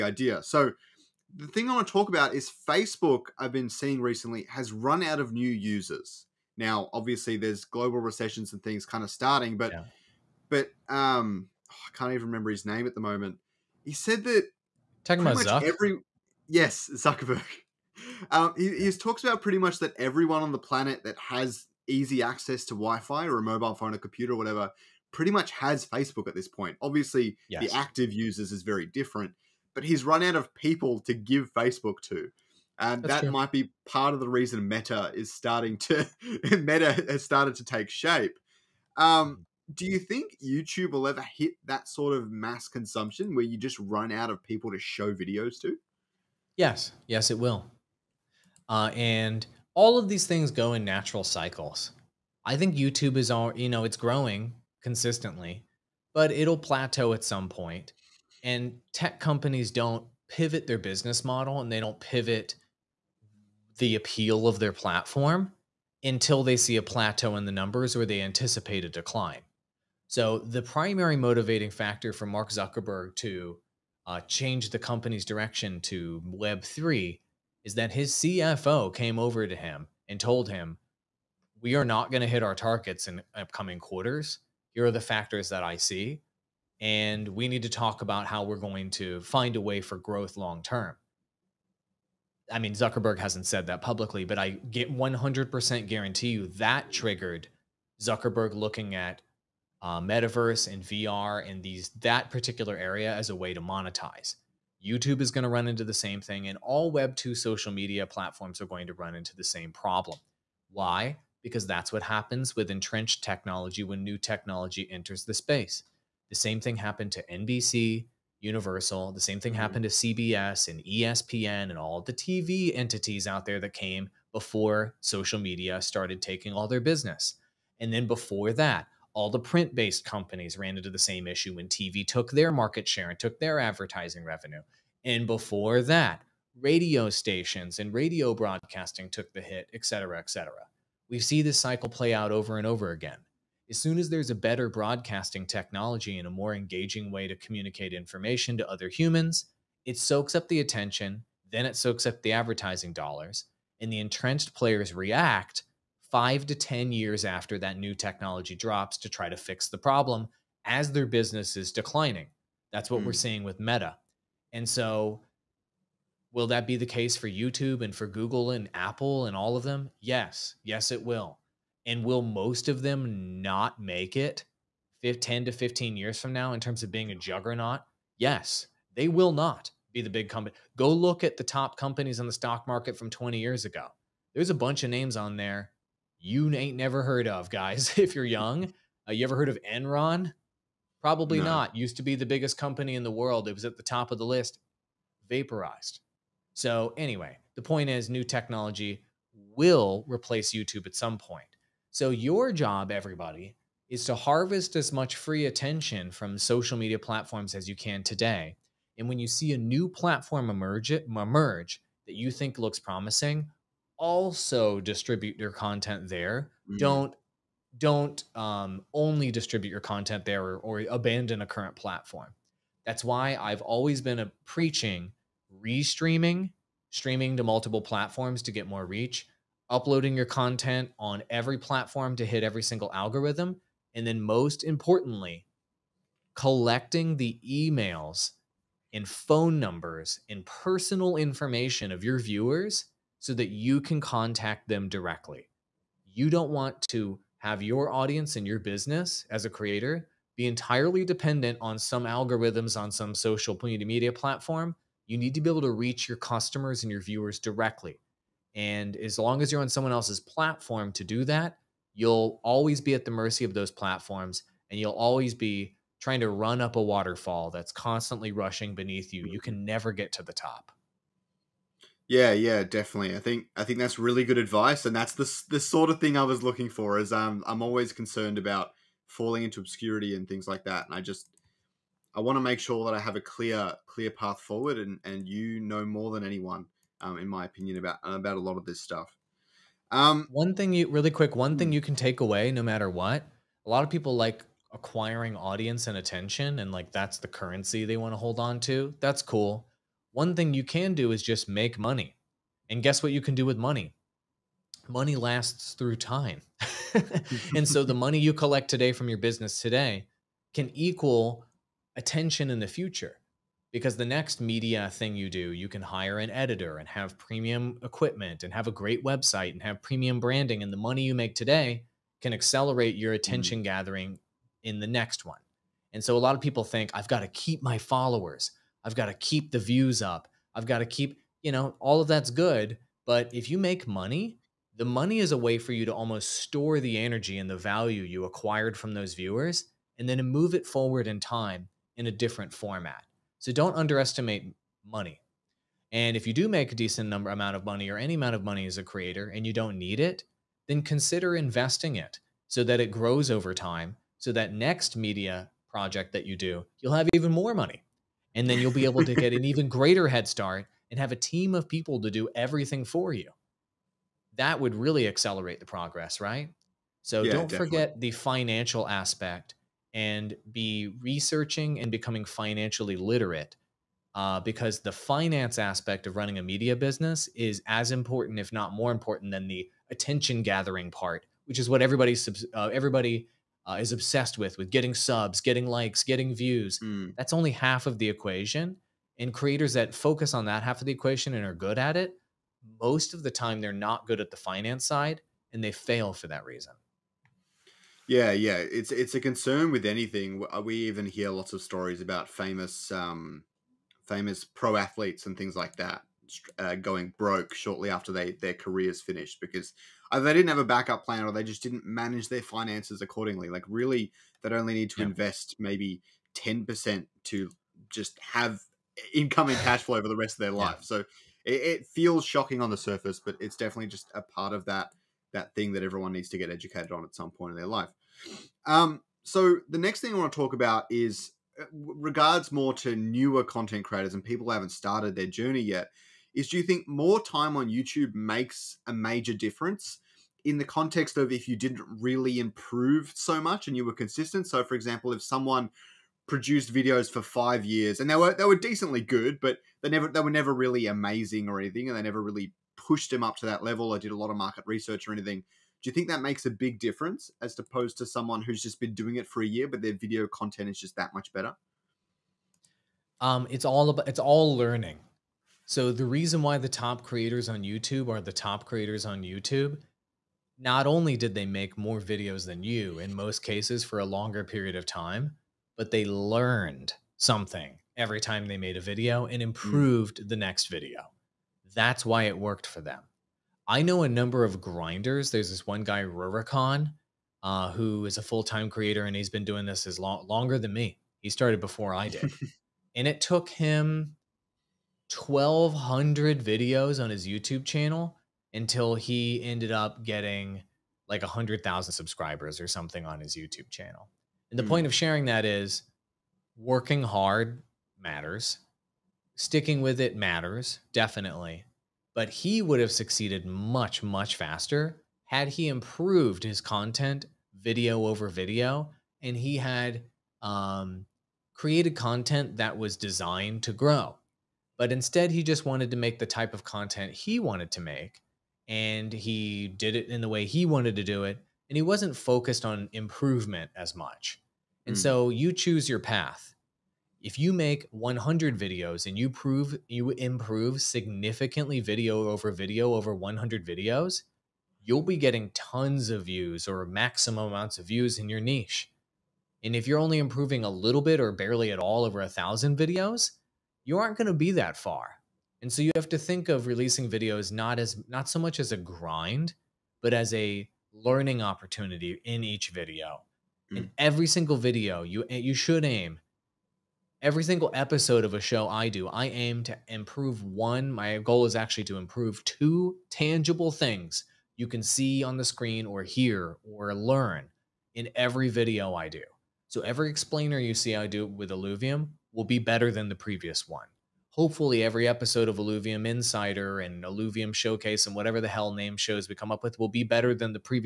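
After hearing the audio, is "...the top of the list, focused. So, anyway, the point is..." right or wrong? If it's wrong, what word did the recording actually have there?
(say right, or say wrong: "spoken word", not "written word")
wrong: "vaporized", not "focused".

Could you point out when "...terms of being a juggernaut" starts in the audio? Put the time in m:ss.
2:56.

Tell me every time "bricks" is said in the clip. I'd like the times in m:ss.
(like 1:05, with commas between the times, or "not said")
not said.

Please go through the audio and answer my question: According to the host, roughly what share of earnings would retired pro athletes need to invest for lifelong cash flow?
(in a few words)
10 percent.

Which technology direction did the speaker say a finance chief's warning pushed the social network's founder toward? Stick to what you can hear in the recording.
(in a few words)
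Web3.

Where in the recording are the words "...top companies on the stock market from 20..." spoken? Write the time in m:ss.
3:01.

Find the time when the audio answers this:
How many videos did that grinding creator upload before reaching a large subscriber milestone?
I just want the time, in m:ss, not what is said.
8:15.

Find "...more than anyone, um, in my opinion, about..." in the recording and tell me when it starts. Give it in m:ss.
4:45.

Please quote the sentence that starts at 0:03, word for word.
I've been seeing recently has run out of new users.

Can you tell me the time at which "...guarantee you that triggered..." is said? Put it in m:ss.
1:35.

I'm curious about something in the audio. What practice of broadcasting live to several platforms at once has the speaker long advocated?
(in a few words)
Restreaming.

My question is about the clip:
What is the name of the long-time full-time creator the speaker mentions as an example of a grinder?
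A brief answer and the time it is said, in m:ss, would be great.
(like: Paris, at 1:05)
Rurikon, at 8:06.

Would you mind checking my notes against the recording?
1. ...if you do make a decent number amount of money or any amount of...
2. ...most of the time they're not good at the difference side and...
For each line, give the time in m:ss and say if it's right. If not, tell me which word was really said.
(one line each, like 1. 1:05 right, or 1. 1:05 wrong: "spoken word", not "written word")
1. 5:46 right
2. 6:32 wrong: "finance", not "difference".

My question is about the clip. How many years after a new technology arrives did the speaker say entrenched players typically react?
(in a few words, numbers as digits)
5 to 10.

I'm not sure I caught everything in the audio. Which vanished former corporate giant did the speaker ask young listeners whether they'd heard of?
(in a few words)
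Enron.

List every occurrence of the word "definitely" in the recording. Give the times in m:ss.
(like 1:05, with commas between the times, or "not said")
4:32, 6:07, 7:03, 8:30.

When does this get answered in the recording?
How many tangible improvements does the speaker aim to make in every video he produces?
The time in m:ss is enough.
9:32.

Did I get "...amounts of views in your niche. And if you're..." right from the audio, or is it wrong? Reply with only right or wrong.
right.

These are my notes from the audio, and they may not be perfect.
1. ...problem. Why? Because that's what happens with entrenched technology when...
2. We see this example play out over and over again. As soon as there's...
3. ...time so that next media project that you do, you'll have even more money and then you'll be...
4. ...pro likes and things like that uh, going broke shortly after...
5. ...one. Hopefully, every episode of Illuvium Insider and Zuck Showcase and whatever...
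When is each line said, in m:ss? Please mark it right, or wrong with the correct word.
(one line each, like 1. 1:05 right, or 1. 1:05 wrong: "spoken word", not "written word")
1. 1:49 right
2. 2:21 wrong: "cycle", not "example"
3. 5:53 right
4. 6:44 wrong: "athletes", not "likes"
5. 9:43 wrong: "Illuvium", not "Zuck".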